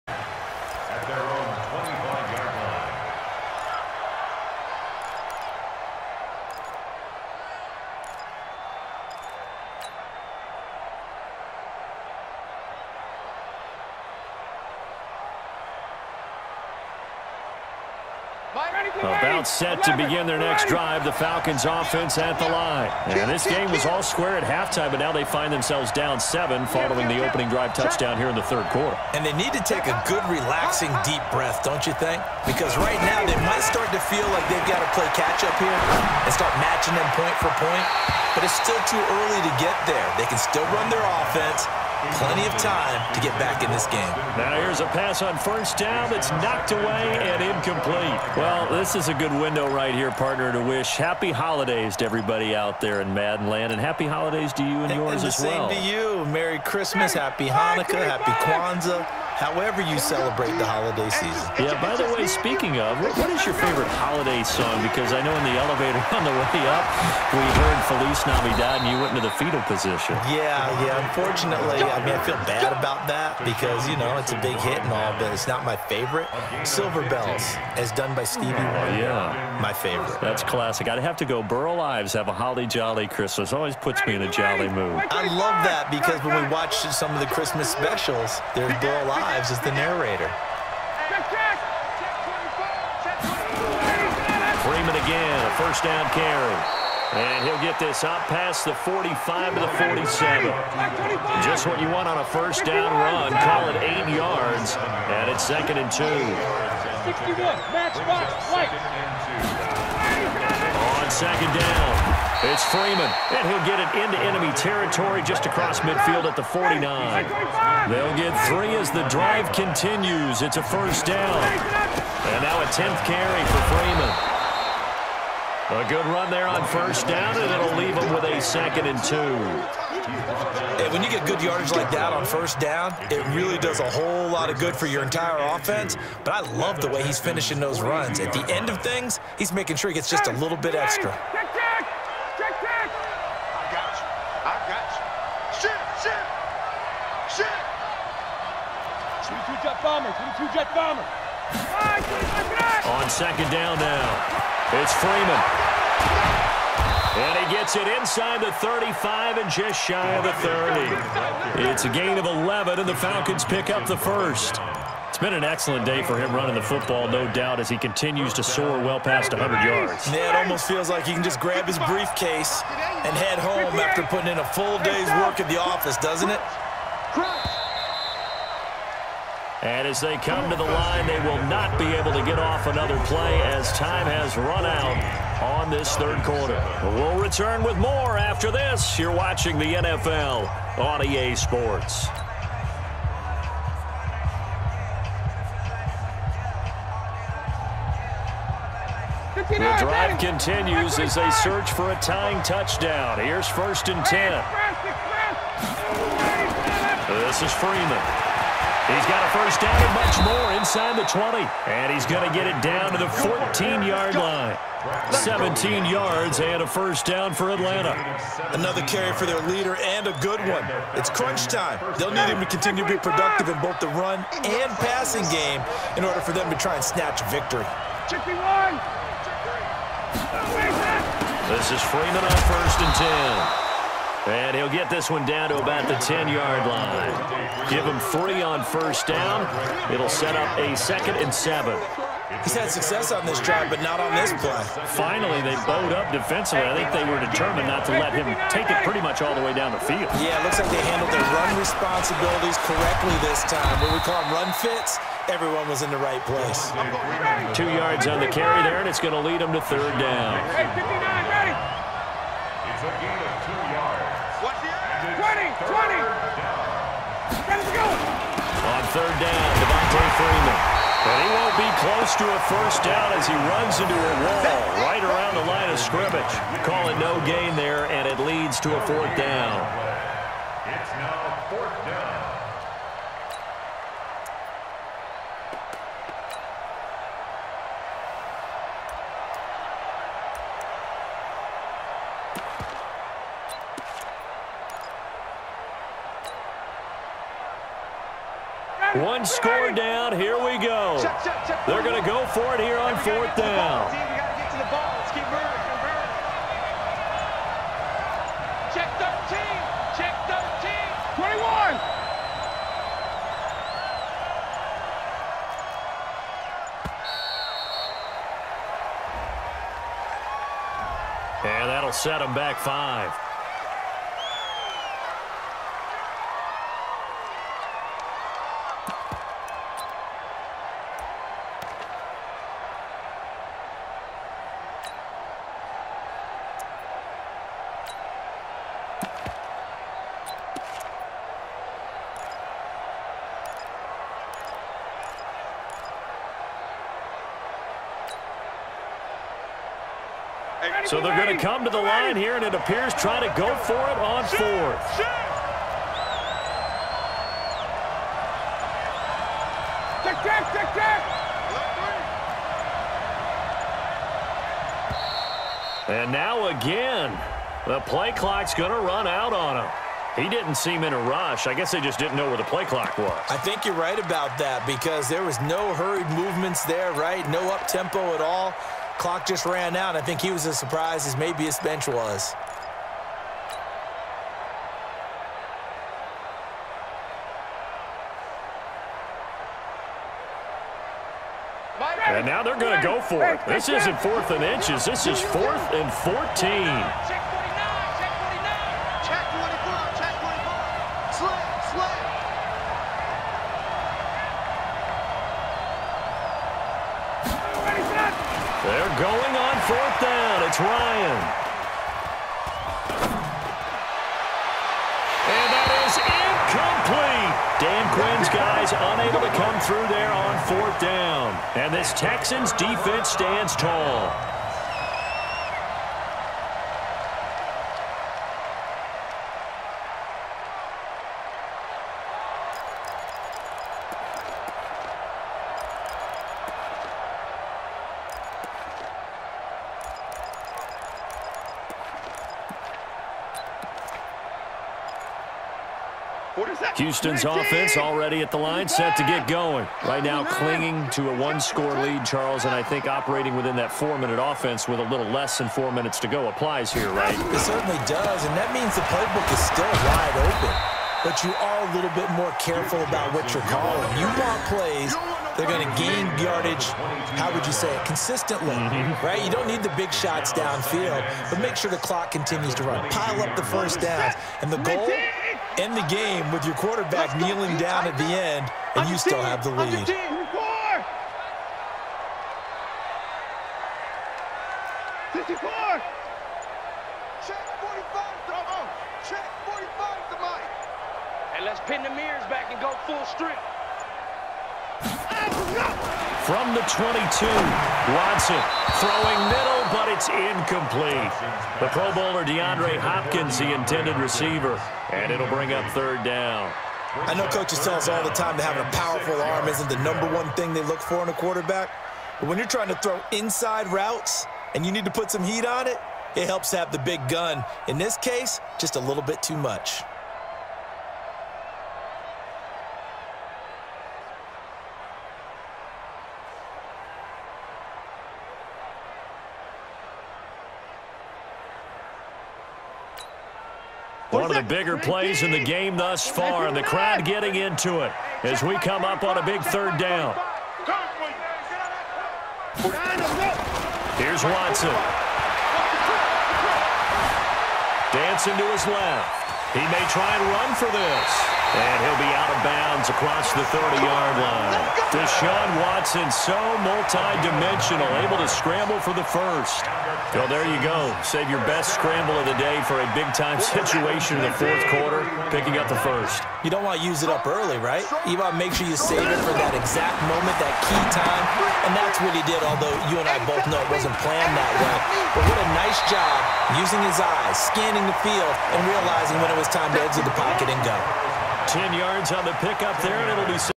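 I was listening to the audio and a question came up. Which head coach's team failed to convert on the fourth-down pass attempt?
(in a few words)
Dan Quinn.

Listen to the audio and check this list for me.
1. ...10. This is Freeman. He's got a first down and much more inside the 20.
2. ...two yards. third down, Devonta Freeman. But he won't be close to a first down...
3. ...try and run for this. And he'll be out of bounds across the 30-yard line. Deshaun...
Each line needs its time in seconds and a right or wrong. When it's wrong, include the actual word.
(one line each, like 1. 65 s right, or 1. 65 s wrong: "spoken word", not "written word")
1. 204 s right
2. 263 s right
3. 549 s right.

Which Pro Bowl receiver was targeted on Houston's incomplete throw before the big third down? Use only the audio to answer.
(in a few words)
DeAndre Hopkins.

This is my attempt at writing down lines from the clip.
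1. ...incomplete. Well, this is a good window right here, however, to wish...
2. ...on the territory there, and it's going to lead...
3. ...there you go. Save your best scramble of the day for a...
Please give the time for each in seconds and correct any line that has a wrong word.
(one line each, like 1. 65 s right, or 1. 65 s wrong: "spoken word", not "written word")
1. 47 s wrong: "partner", not "however"
2. 258 s wrong: "carry", not "territory"
3. 560 s right.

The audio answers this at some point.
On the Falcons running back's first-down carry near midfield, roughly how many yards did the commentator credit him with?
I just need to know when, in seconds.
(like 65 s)
103 s.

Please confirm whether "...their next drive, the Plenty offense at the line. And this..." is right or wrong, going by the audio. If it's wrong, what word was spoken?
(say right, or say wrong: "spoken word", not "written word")
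wrong: "Falcons", not "Plenty".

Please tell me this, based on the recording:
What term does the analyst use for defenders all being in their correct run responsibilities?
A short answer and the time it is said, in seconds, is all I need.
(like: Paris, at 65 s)
run fits, at 254 s.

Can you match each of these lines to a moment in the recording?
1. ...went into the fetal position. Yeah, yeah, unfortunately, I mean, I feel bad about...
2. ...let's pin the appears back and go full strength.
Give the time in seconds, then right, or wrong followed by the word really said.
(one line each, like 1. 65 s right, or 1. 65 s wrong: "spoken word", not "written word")
1. 69 s right
2. 491 s wrong: "mirrors", not "appears".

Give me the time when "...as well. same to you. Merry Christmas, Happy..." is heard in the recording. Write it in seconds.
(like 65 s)
55 s.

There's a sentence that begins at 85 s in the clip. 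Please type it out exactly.
I love that because when we watch some of the Christmas specials, there's Burl Ives.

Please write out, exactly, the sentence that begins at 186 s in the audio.
We'll return with more after this.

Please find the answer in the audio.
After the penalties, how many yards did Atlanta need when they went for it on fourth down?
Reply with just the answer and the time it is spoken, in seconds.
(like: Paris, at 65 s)
14, at 395 s.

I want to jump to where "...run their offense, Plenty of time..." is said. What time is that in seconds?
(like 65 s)
40 s.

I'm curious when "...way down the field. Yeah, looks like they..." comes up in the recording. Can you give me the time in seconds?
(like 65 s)
249 s.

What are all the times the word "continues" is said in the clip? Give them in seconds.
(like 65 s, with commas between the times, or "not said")
119 s, 167 s, 200 s, 222 s, 472 s.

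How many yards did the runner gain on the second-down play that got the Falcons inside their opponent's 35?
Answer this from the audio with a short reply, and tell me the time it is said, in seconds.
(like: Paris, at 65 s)
11, at 161 s.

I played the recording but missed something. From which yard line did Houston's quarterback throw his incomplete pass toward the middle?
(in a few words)
22.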